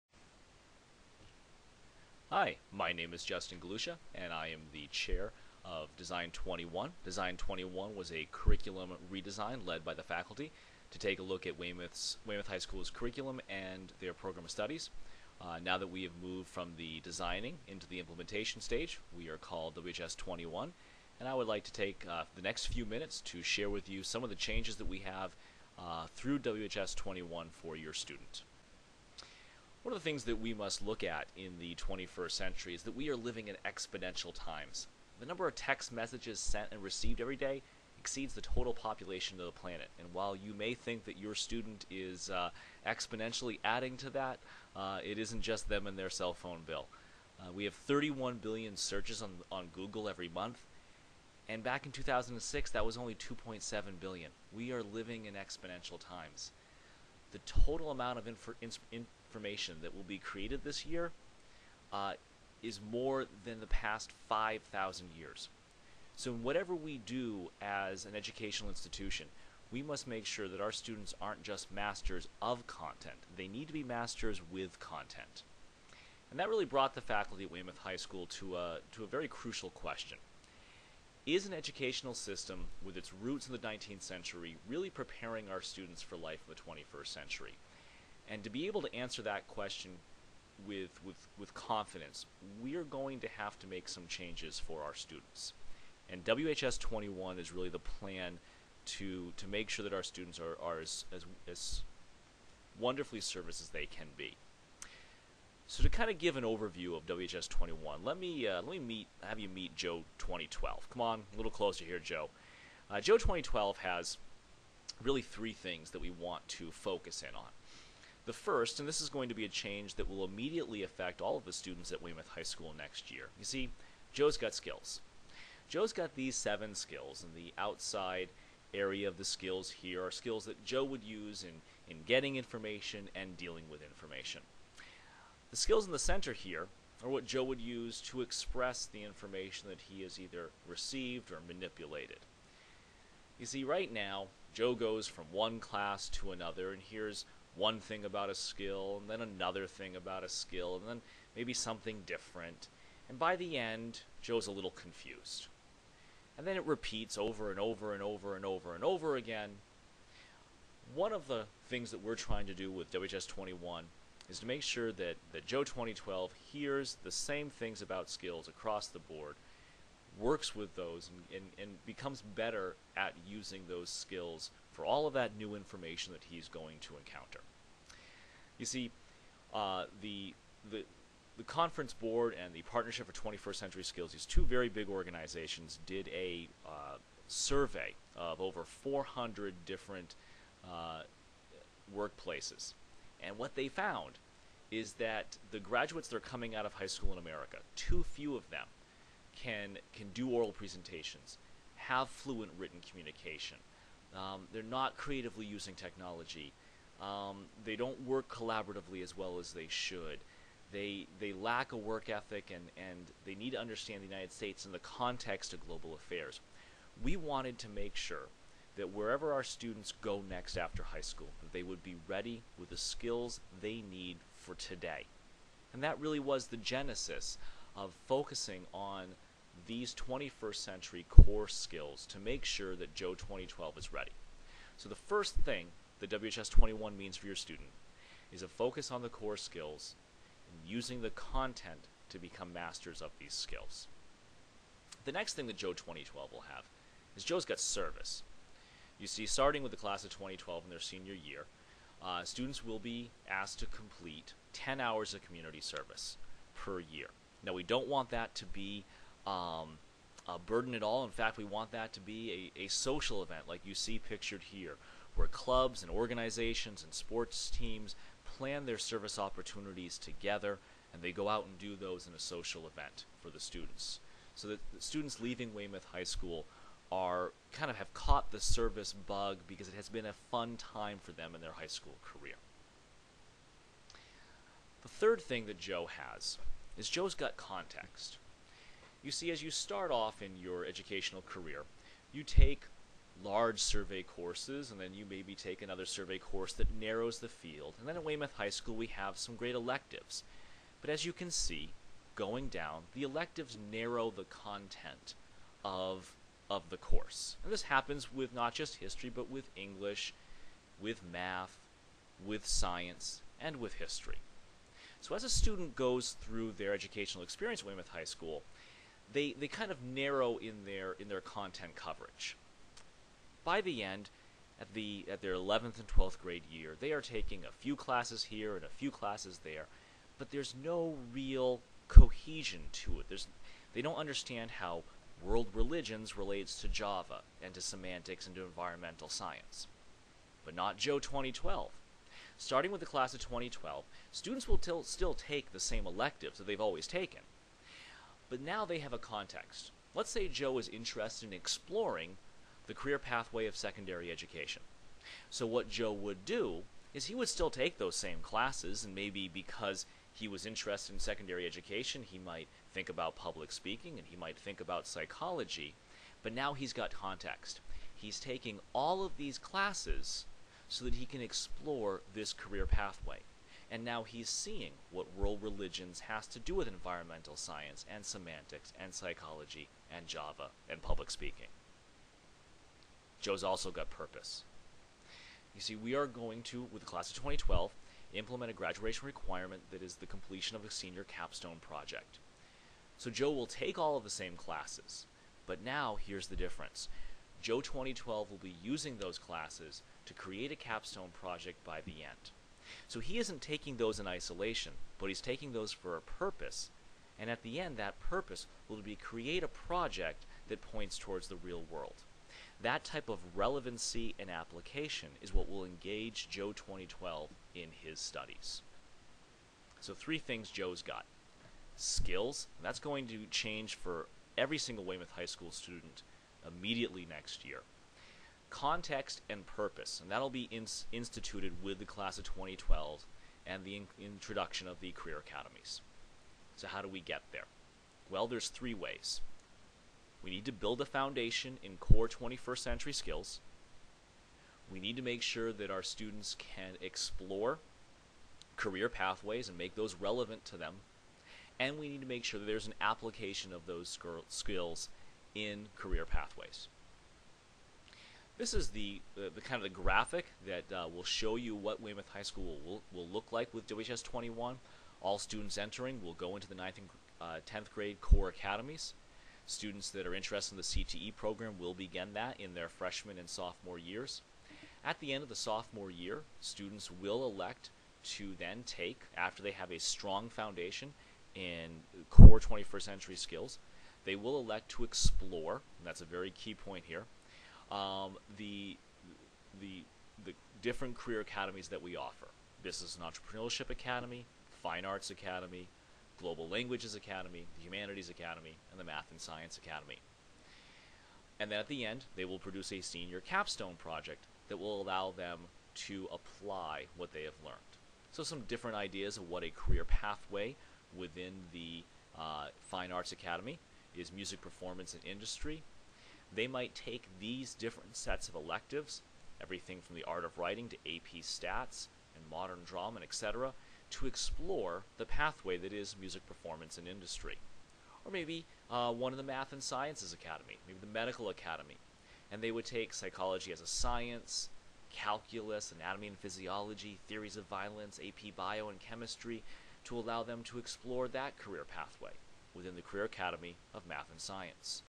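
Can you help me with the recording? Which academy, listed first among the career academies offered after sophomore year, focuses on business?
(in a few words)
Business and Entrepreneurship Academy.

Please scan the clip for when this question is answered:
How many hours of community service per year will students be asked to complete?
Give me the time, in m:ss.
4:14.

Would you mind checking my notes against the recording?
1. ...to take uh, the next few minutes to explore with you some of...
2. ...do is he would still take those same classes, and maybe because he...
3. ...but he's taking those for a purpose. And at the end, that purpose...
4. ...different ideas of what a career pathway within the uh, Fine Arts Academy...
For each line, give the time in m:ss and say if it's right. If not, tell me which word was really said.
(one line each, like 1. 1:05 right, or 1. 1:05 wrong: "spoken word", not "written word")
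1. 0:21 wrong: "share", not "explore"
2. 5:56 right
3. 6:44 right
4. 8:28 right.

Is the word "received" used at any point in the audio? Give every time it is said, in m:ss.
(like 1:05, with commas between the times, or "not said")
0:36, 2:20.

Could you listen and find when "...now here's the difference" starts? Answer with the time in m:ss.
6:35.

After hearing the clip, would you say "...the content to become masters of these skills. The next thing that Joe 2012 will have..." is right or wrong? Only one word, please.
right.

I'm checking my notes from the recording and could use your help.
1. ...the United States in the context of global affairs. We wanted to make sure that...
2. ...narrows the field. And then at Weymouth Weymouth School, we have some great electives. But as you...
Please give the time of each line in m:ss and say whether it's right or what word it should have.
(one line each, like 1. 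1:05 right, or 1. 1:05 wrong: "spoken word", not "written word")
1. 3:34 right
2. 4:56 wrong: "High", not "Weymouth".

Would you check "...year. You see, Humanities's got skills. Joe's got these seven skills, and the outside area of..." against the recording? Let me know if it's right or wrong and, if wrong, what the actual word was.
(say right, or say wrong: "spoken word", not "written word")
wrong: "Joe", not "Humanities".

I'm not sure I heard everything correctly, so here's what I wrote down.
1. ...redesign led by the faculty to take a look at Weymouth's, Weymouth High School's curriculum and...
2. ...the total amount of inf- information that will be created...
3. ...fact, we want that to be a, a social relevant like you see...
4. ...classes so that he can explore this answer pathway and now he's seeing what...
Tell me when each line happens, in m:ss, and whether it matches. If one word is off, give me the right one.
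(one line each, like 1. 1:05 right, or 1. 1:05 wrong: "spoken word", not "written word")
1. 0:09 right
2. 0:57 right
3. 4:21 wrong: "event", not "relevant"
4. 6:09 wrong: "career", not "answer".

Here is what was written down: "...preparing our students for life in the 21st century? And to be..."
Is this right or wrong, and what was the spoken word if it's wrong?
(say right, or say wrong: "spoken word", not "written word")
right.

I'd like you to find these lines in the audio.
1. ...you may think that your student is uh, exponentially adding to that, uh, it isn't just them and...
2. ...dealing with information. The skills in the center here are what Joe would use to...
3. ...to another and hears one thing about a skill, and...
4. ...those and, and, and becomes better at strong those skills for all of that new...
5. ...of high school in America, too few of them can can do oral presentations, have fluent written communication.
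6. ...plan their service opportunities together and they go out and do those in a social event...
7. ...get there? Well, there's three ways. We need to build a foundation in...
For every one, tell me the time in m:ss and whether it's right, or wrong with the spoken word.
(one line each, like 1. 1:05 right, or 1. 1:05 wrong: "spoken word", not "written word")
1. 0:40 right
2. 2:13 right
3. 2:26 right
4. 2:50 wrong: "using", not "strong"
5. 3:16 right
6. 4:28 right
7. 7:16 right.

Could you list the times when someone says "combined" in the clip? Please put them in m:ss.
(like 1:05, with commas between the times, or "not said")
not said.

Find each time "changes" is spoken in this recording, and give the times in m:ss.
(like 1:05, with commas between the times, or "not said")
0:24, 1:34, 1:59, 7:03.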